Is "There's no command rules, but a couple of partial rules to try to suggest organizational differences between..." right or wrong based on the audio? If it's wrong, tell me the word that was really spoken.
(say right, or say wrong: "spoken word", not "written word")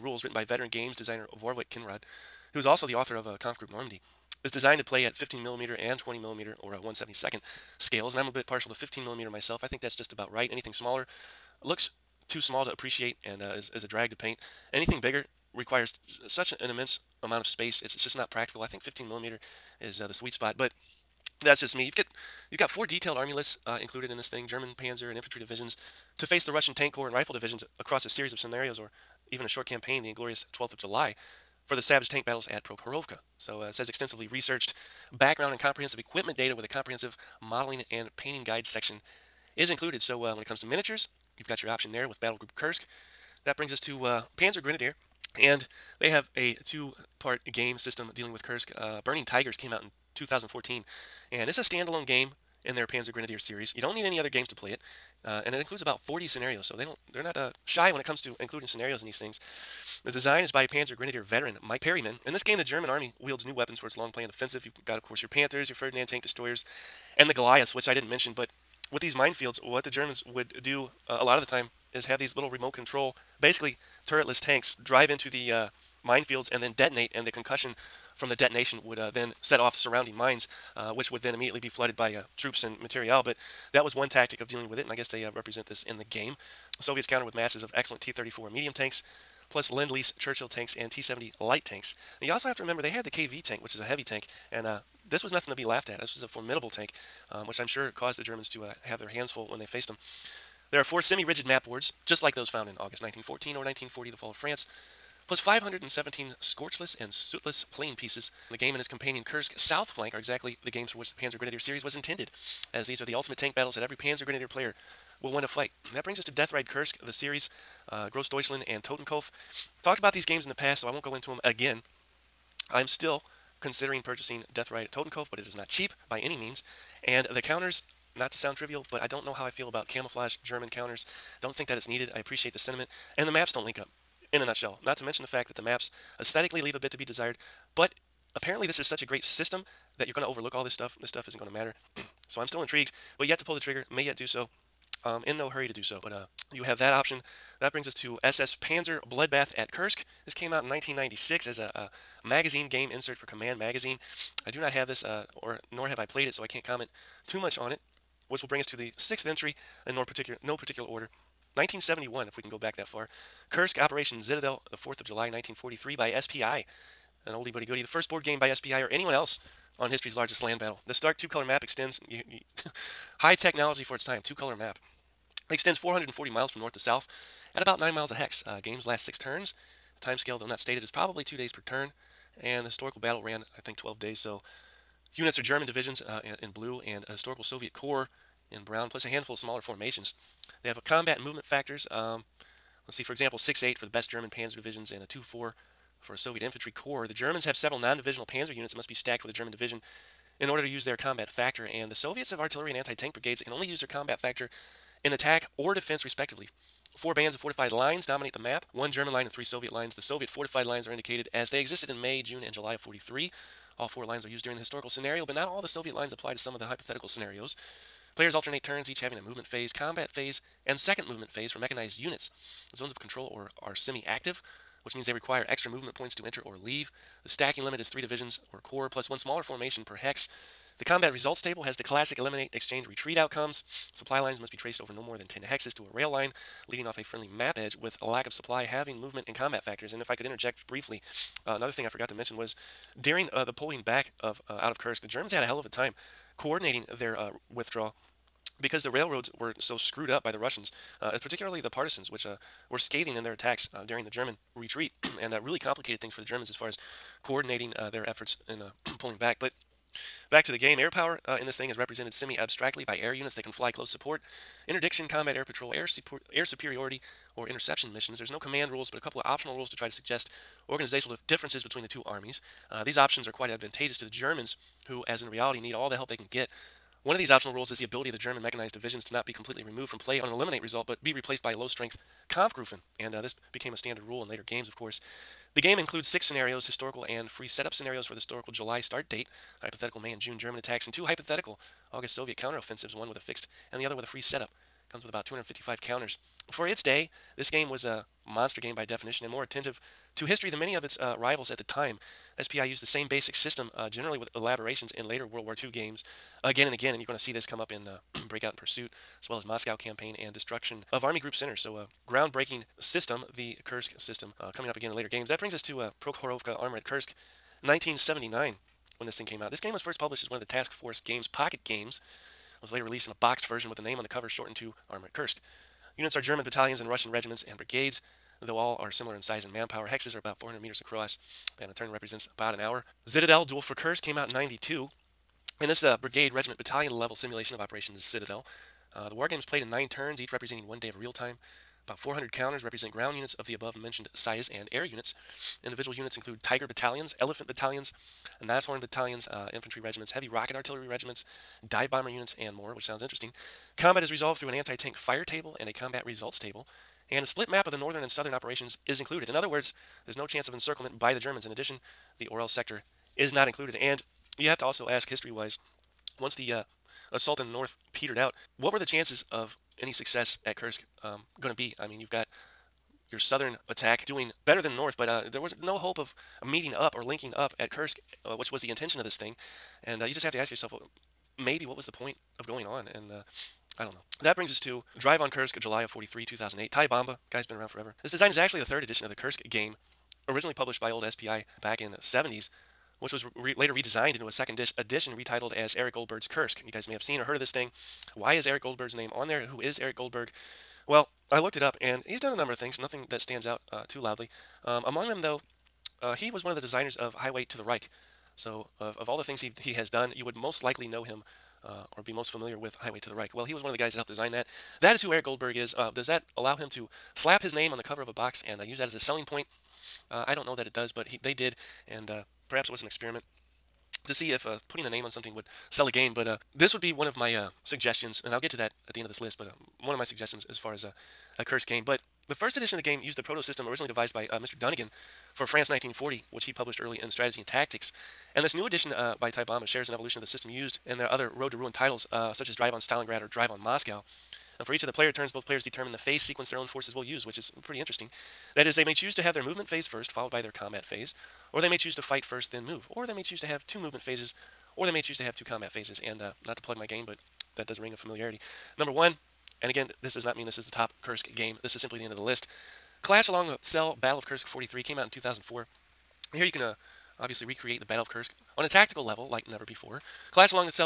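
wrong: "optional", not "partial".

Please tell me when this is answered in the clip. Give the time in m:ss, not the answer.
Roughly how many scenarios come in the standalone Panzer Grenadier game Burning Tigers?
0:55.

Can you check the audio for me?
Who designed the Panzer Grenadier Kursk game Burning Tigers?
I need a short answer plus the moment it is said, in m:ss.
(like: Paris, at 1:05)
Mike Perryman, at 1:01.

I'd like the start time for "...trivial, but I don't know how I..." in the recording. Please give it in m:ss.
2:08.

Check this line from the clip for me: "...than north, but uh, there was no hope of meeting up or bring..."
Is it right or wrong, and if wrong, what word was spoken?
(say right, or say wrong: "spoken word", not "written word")
wrong: "linking", not "bring".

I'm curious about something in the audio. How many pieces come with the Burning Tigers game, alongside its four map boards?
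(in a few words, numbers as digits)
517.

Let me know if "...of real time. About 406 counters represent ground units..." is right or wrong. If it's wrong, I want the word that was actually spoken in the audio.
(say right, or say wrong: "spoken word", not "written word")
wrong: "400", not "406".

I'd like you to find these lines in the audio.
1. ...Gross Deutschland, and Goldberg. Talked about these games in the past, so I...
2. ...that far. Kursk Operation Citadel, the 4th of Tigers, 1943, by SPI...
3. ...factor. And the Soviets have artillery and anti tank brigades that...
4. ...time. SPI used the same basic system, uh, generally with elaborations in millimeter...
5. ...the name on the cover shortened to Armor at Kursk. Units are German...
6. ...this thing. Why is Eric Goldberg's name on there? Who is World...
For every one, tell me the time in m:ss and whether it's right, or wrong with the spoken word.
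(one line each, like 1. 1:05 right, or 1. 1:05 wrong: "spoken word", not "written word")
1. 1:58 wrong: "Totenkopf", not "Goldberg"
2. 2:42 wrong: "July", not "Tigers"
3. 3:21 right
4. 5:01 wrong: "later", not "millimeter"
5. 5:23 right
6. 6:37 wrong: "Eric", not "World".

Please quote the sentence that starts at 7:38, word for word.
Number one, and again, this does not mean this is the top Kursk game.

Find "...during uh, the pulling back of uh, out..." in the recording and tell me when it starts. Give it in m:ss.
4:03.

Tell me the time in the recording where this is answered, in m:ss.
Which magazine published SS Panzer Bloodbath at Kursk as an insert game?
2:33.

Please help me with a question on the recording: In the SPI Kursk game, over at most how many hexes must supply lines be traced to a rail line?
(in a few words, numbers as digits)
10.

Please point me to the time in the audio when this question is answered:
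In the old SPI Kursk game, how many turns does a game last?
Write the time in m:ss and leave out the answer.
2:59.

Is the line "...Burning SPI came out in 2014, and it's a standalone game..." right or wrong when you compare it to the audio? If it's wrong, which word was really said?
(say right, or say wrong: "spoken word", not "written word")
wrong: "Tigers", not "SPI".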